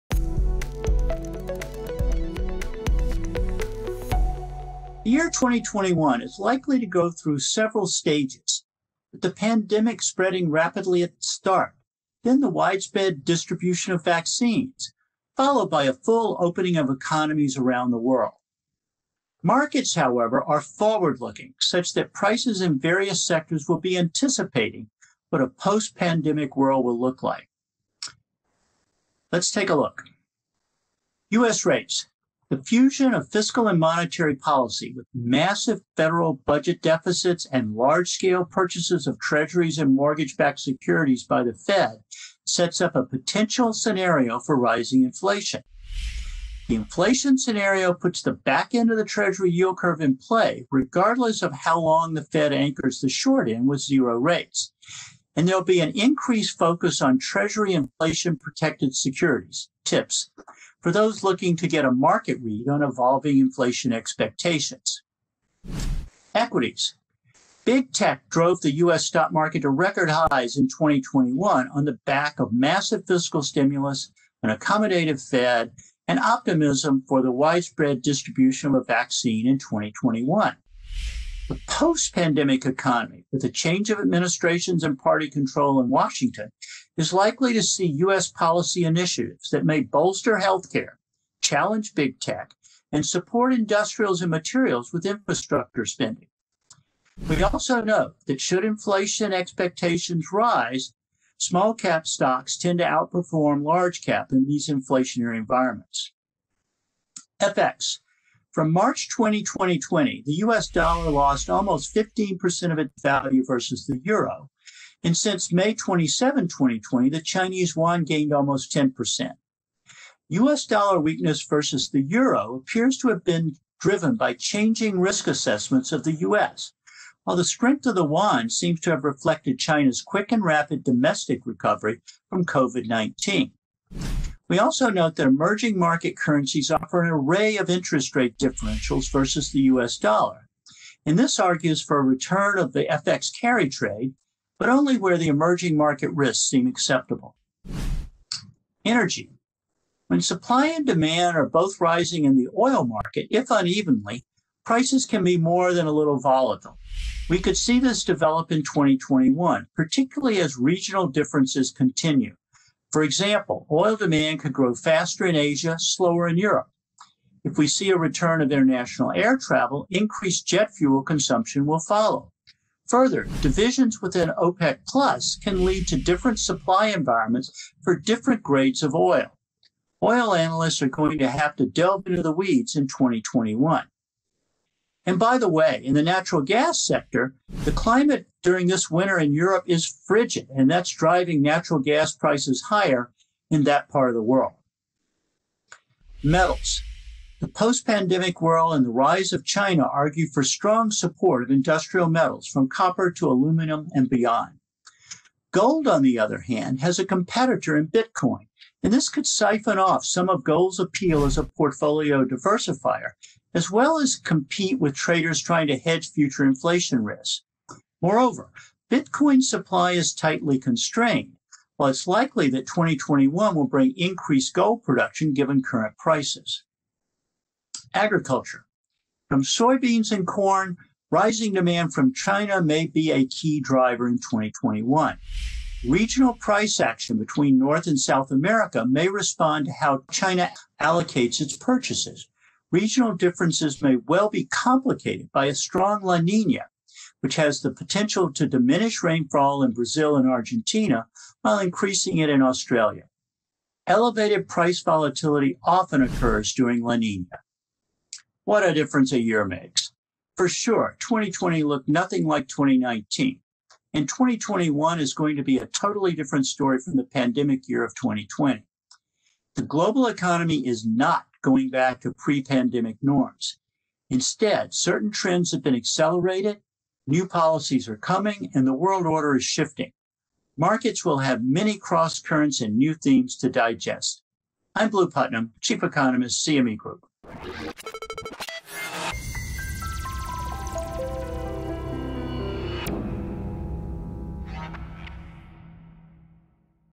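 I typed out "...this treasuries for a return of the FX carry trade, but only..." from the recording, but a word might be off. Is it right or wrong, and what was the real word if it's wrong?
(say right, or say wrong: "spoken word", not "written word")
wrong: "argues", not "treasuries".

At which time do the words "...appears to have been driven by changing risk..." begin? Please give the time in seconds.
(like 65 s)
122 s.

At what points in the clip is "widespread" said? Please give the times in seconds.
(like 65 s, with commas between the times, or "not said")
12 s, 77 s.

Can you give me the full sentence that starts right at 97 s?
We also know that should inflation expectations rise, small cap stocks tend to outperform large cap in these inflationary environments.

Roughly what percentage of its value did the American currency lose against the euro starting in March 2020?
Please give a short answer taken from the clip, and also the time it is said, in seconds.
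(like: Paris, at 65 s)
15%, at 111 s.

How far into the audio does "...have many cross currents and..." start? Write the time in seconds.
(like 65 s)
281 s.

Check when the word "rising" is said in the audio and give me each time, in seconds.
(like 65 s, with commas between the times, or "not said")
44 s, 151 s, 231 s.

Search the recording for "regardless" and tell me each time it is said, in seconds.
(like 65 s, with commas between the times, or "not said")
50 s.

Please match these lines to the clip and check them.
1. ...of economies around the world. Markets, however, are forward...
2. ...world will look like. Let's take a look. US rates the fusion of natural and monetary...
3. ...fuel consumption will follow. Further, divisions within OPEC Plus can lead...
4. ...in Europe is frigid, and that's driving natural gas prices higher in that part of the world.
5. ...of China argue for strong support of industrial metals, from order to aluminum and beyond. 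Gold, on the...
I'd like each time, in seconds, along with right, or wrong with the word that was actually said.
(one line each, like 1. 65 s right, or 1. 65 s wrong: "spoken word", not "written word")
1. 16 s right
2. 26 s wrong: "fiscal", not "natural"
3. 170 s right
4. 189 s right
5. 199 s wrong: "copper", not "order".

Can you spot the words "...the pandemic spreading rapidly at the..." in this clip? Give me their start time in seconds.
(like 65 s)
9 s.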